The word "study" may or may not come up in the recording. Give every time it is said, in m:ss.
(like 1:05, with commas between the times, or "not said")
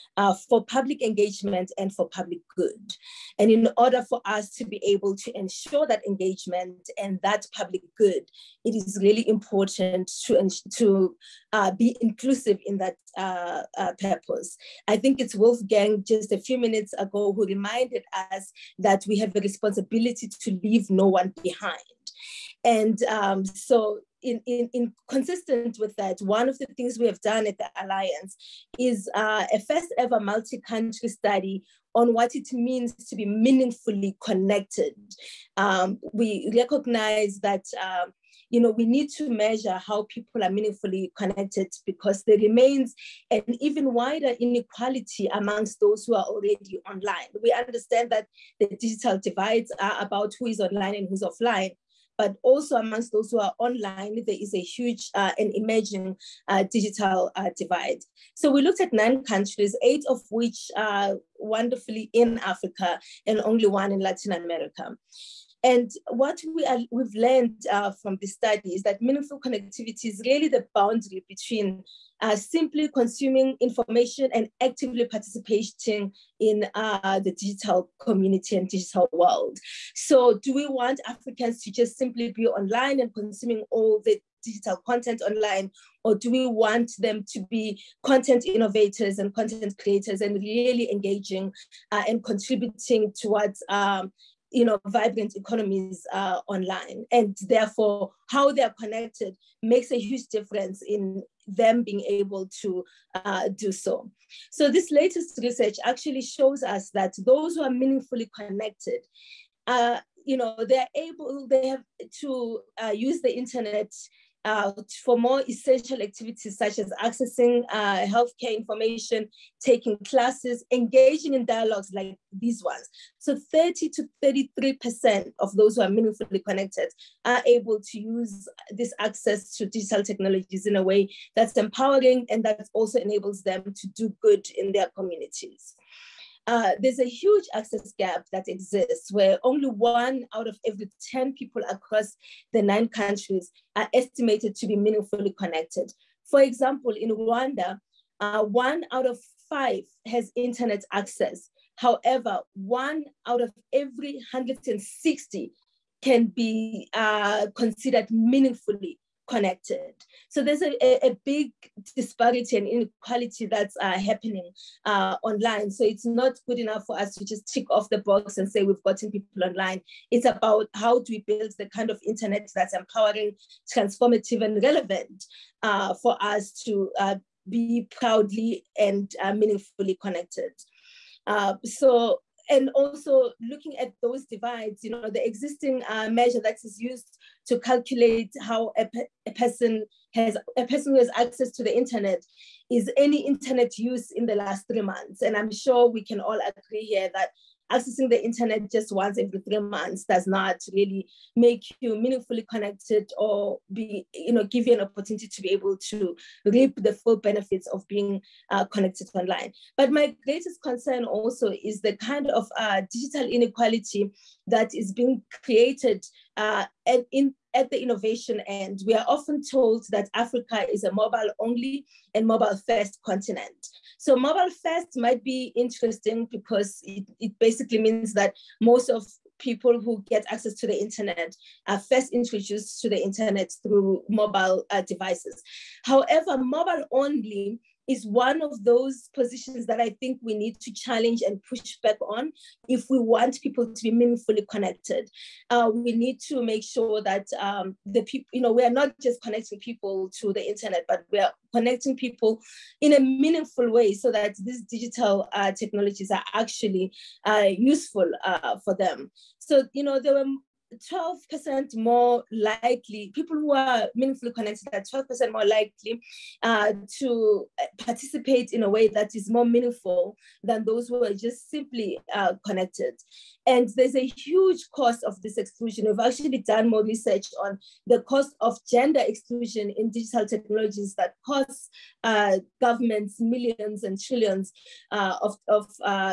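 0:31, 1:08.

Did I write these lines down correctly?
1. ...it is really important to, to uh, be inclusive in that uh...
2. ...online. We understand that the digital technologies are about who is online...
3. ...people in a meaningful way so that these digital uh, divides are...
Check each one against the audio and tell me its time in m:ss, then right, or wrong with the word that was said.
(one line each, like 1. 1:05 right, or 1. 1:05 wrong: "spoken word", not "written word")
1. 0:08 right
2. 0:46 wrong: "divides", not "technologies"
3. 4:11 wrong: "technologies", not "divides".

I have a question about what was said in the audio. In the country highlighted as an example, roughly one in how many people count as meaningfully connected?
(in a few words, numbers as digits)
160.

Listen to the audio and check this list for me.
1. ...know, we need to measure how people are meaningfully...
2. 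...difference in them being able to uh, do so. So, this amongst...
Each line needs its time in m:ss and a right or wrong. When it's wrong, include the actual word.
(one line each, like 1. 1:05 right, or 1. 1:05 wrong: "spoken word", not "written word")
1. 0:38 right
2. 1:40 wrong: "latest", not "amongst".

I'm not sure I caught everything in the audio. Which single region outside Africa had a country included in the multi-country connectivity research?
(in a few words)
Latin America.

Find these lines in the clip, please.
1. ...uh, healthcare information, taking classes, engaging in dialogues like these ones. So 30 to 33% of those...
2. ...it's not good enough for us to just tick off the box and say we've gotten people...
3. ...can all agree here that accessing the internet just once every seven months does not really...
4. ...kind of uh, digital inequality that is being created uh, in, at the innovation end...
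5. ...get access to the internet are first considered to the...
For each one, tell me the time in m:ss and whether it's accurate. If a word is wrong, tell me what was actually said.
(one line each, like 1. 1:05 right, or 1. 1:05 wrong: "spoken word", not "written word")
1. 1:57 right
2. 2:45 right
3. 3:16 wrong: "three", not "seven"
4. 3:31 right
5. 3:50 wrong: "introduced", not "considered".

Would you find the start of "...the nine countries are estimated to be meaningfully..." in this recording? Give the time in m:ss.
2:22.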